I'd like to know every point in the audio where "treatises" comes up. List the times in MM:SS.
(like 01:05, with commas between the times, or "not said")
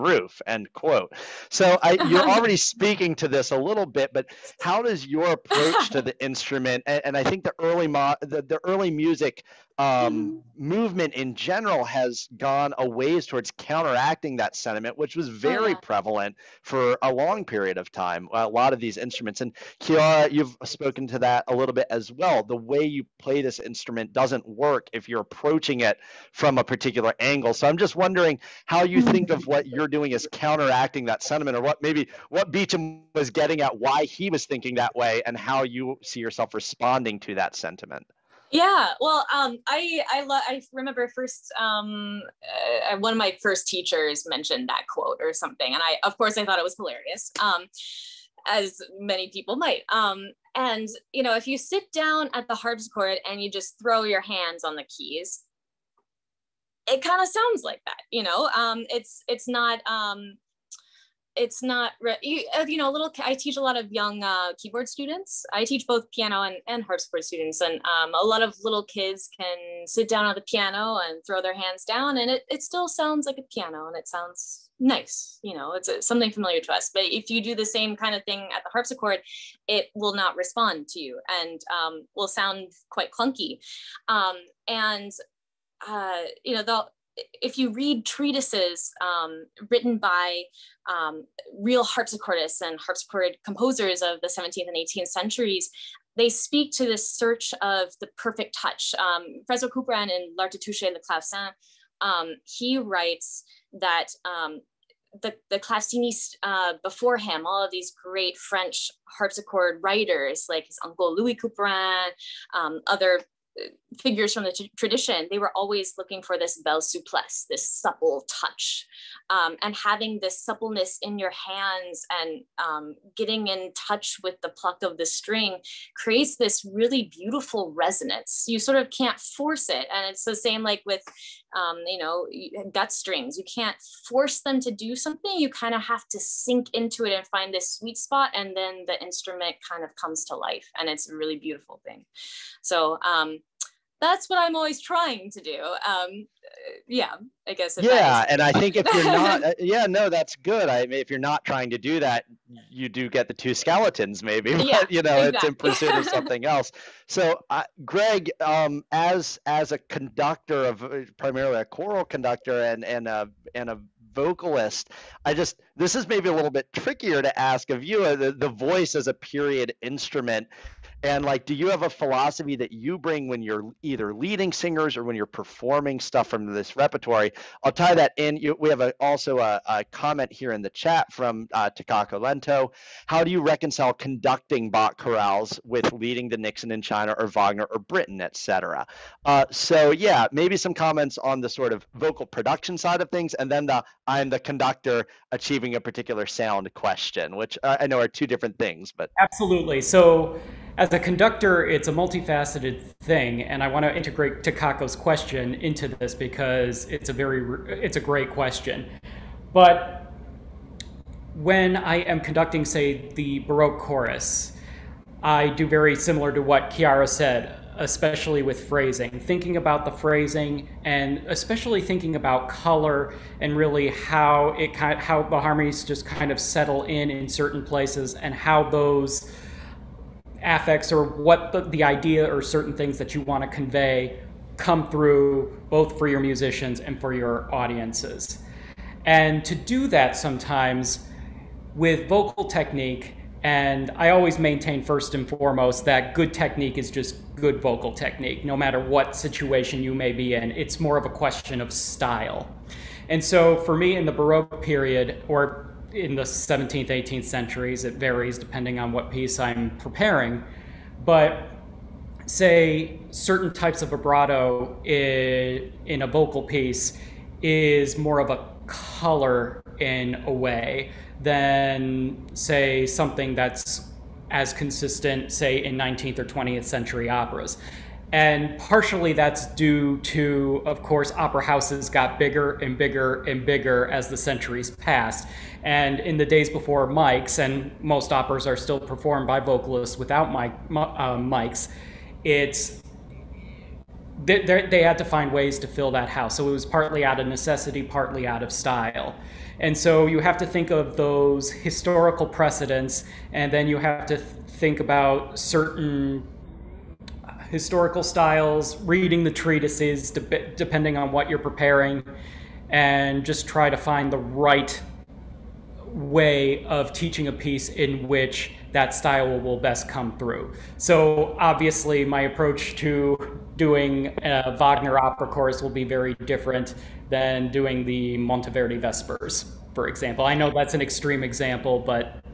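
01:28, 05:09.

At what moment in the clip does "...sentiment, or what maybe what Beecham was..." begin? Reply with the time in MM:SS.
00:31.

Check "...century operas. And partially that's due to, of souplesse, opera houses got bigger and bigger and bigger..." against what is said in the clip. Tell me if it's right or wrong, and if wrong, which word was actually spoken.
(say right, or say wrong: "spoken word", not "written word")
wrong: "course", not "souplesse".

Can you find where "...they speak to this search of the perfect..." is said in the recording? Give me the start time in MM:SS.
01:36.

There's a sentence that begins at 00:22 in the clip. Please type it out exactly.
The way you play this instrument doesn't work if you're approaching it from a particular angle.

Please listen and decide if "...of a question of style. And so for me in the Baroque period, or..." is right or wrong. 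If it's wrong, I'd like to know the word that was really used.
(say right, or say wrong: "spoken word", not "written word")
right.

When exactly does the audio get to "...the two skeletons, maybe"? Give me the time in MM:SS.
02:33.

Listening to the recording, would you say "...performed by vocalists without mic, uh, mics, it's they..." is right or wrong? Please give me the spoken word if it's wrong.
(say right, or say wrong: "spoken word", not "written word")
right.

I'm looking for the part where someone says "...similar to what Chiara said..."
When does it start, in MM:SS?
03:35.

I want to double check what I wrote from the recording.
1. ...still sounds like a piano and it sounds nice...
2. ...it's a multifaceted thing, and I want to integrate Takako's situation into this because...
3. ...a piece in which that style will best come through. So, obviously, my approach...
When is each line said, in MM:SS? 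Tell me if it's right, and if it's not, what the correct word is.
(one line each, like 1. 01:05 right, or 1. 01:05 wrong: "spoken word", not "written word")
1. 01:12 right
2. 03:21 wrong: "question", not "situation"
3. 05:17 right.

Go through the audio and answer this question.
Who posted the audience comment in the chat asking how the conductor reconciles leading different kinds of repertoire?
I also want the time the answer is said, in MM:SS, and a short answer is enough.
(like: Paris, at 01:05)
Takako Lento, at 03:01.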